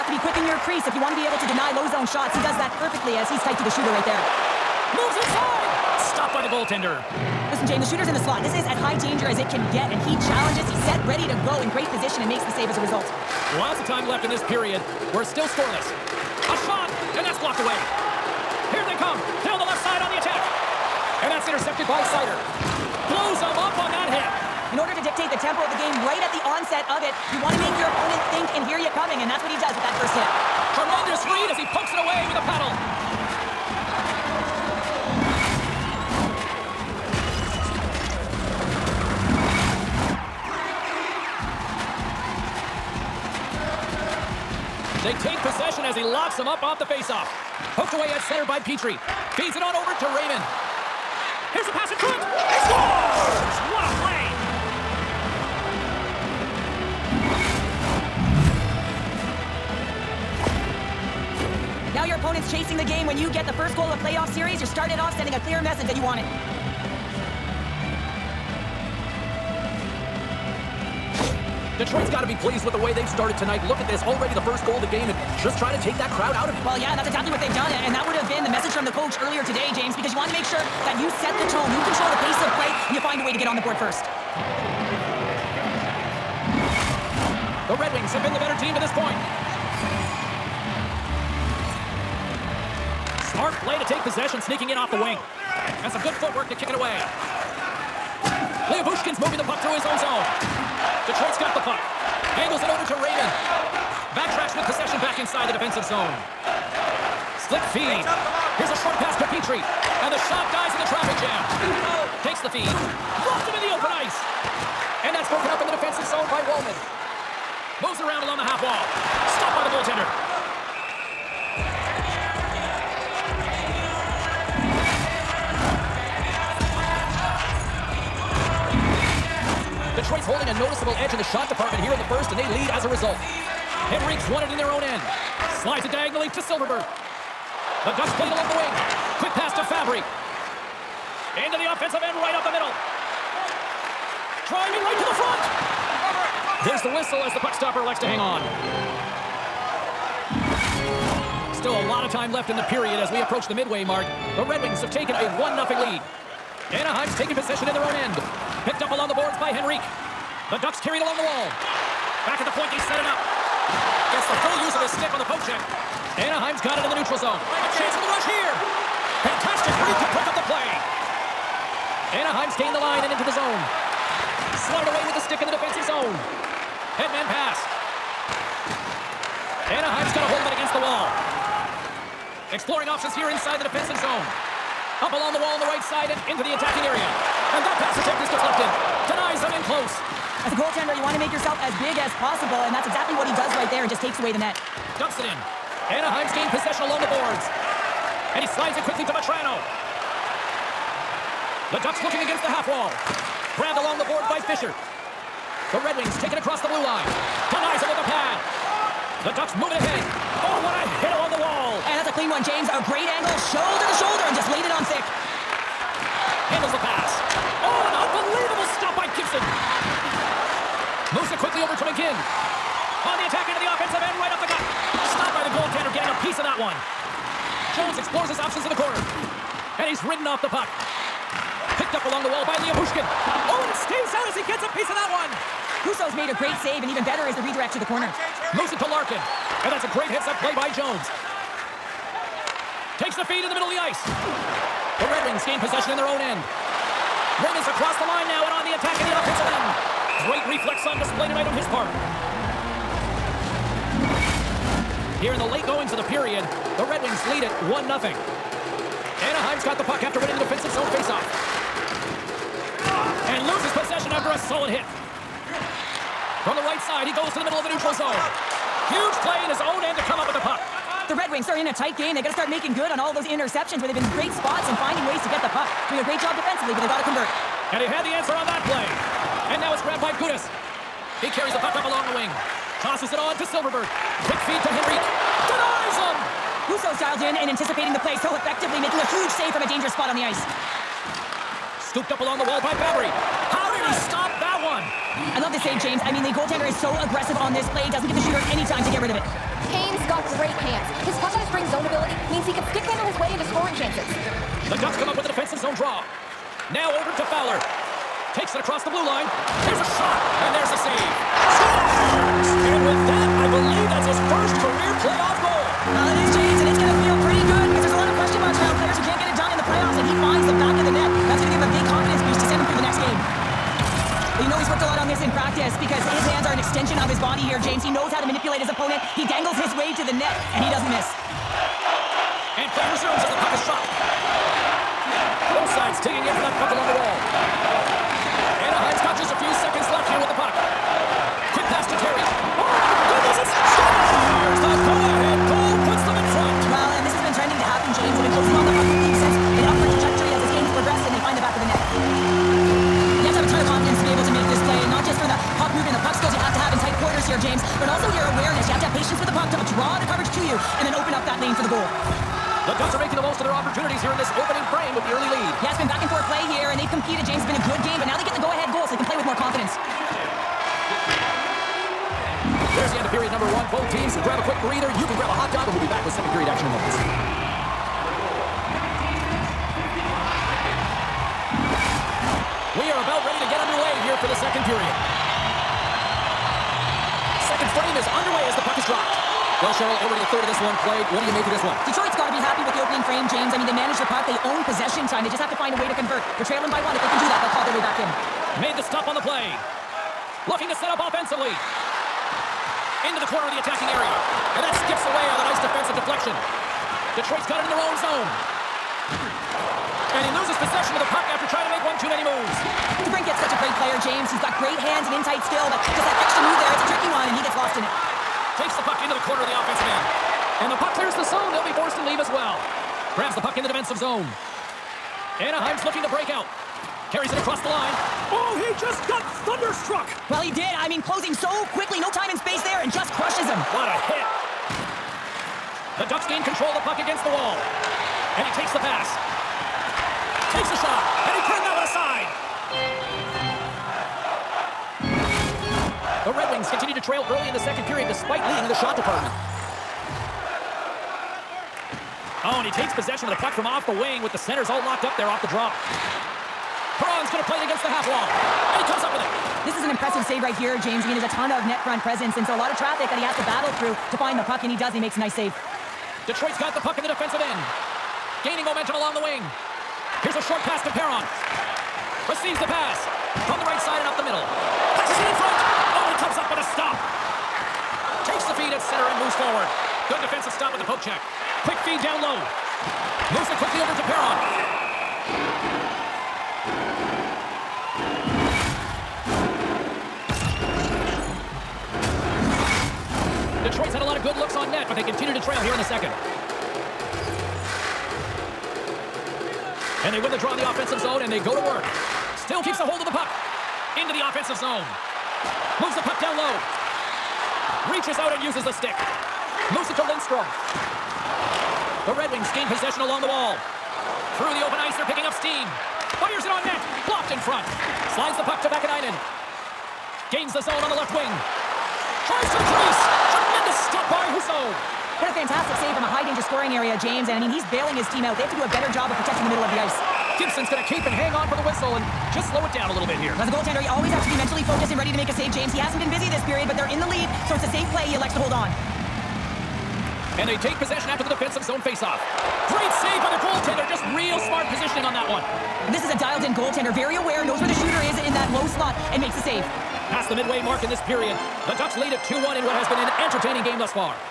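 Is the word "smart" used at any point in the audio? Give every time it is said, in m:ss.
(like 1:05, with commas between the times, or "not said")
1:33, 9:04.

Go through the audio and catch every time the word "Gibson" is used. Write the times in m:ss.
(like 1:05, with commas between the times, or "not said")
3:39, 8:50.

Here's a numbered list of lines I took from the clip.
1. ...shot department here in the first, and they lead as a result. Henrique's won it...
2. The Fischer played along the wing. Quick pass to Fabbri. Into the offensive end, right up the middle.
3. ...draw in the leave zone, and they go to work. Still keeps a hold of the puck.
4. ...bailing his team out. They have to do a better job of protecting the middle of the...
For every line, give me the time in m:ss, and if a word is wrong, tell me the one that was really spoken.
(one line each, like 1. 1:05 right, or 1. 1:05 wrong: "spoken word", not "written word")
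1. 2:11 right
2. 2:17 wrong: "Ducks", not "Fischer"
3. 8:20 wrong: "offensive", not "leave"
4. 8:47 right.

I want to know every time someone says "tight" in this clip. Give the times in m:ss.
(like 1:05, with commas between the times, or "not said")
0:03, 4:31, 6:55.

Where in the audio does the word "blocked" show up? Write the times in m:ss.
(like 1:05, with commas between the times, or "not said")
0:17, 8:37.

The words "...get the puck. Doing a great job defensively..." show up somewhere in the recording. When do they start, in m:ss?
4:35.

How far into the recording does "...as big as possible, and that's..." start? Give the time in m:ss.
3:11.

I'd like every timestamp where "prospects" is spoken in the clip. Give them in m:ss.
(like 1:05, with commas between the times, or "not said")
not said.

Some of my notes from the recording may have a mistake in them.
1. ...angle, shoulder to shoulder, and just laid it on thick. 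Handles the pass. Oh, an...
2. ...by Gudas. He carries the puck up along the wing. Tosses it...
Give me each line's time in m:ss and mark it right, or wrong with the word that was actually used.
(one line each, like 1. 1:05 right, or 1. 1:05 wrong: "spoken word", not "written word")
1. 3:33 right
2. 4:40 right.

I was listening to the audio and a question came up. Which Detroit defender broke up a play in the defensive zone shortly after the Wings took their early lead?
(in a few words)
Walman.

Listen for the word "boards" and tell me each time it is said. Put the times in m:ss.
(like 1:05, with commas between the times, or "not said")
1:23, 2:39, 3:17, 3:24.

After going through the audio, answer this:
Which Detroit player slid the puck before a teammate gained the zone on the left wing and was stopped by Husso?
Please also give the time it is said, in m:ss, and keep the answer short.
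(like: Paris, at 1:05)
Vaakanainen, at 8:38.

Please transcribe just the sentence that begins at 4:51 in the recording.
Scooped up along the wall by Fabbri.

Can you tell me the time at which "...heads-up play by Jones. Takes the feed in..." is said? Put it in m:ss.
4:00.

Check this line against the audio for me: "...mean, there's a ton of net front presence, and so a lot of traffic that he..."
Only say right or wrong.
right.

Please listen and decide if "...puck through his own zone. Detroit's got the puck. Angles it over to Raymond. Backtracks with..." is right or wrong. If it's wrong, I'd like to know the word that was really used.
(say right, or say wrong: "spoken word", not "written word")
right.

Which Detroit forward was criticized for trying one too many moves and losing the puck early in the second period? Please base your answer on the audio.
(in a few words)
DeBrincat.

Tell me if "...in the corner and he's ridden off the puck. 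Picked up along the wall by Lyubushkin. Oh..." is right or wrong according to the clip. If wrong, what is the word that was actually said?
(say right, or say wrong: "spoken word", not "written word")
right.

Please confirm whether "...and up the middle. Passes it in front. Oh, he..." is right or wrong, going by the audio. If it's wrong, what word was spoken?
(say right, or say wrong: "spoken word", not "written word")
right.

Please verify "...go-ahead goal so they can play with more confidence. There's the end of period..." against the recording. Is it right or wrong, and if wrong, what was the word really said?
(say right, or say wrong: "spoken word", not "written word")
right.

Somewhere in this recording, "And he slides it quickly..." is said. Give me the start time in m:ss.
3:18.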